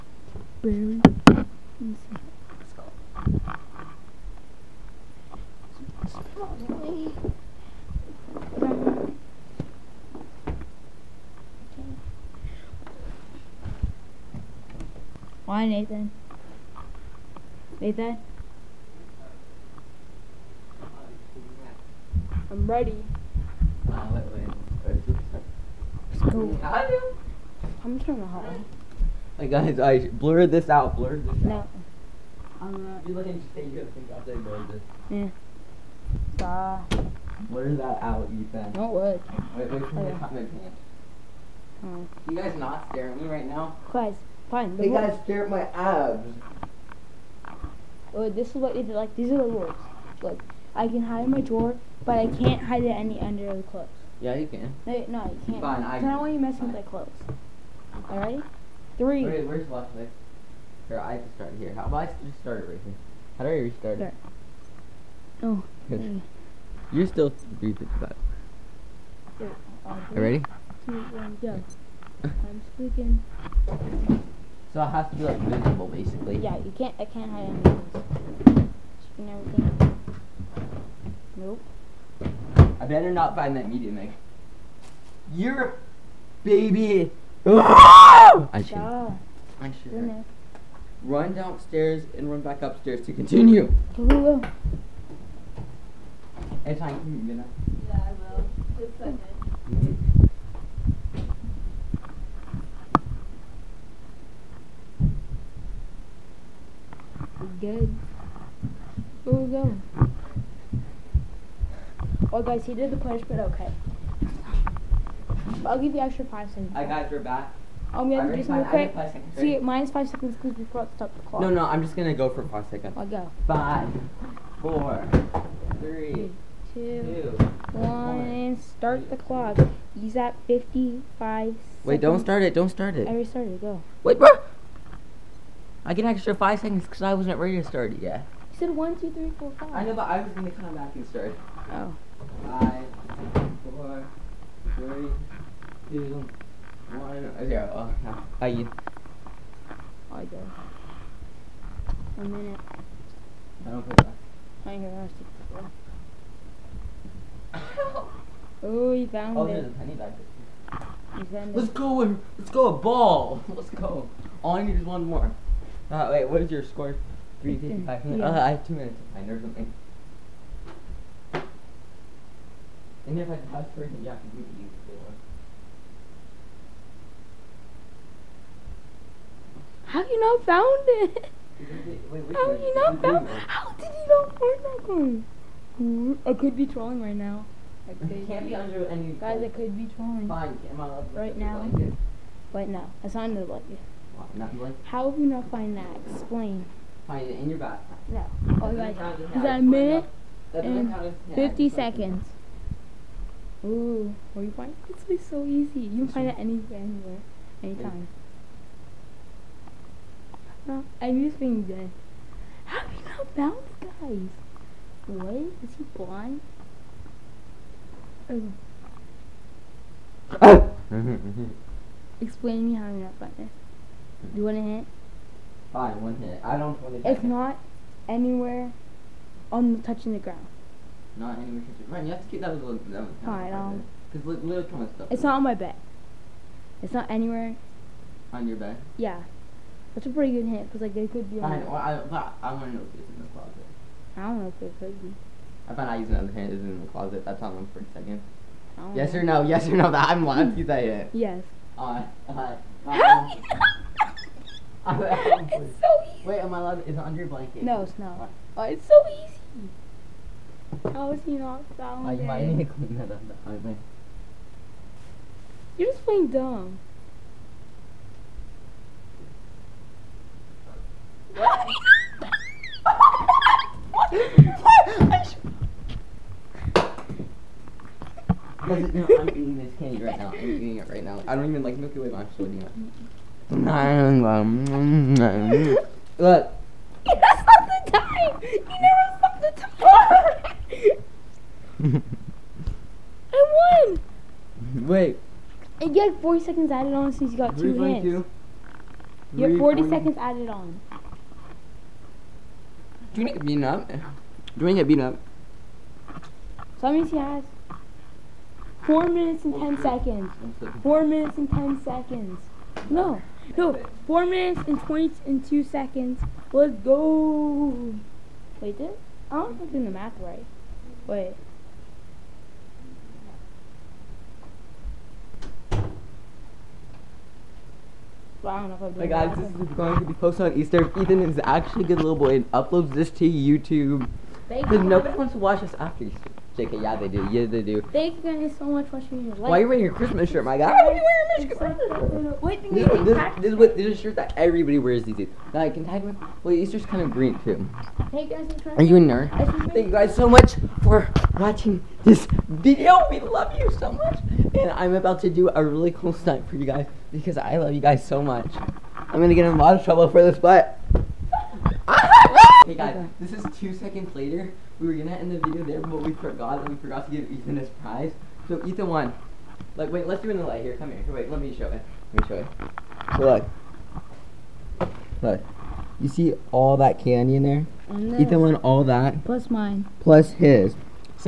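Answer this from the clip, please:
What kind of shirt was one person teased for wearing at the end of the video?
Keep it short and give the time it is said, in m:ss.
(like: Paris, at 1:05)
Christmas shirt, at 5:39.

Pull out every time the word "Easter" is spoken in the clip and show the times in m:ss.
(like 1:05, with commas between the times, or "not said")
5:30, 5:36, 5:46.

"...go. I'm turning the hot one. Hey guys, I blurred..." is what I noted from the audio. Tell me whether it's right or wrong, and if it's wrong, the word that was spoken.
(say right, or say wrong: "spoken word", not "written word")
right.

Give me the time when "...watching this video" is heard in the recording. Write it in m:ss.
5:51.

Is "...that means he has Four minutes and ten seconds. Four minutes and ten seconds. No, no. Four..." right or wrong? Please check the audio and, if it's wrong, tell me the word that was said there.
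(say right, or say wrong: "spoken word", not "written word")
right.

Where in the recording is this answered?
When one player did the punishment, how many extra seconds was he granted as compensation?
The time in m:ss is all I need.
1:55.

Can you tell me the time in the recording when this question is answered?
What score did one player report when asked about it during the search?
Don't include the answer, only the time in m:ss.
2:47.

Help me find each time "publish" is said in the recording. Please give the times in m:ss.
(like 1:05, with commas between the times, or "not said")
not said.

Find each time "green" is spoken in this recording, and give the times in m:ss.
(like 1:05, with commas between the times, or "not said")
5:47.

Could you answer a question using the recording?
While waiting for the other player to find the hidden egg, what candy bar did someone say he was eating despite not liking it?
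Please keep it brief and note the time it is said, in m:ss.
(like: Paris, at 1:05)
Milky Way, at 4:41.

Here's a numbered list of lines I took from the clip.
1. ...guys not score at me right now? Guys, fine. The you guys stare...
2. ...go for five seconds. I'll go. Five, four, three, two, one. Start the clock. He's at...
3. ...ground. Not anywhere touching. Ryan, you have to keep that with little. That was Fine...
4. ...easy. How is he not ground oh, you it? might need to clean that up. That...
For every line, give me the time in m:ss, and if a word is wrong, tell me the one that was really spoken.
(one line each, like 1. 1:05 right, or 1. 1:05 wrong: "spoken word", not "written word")
1. 0:42 wrong: "stare", not "score"
2. 2:02 right
3. 3:50 right
4. 4:19 wrong: "found", not "ground".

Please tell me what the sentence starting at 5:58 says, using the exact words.
I'm going to get in a lot of trouble for this, but...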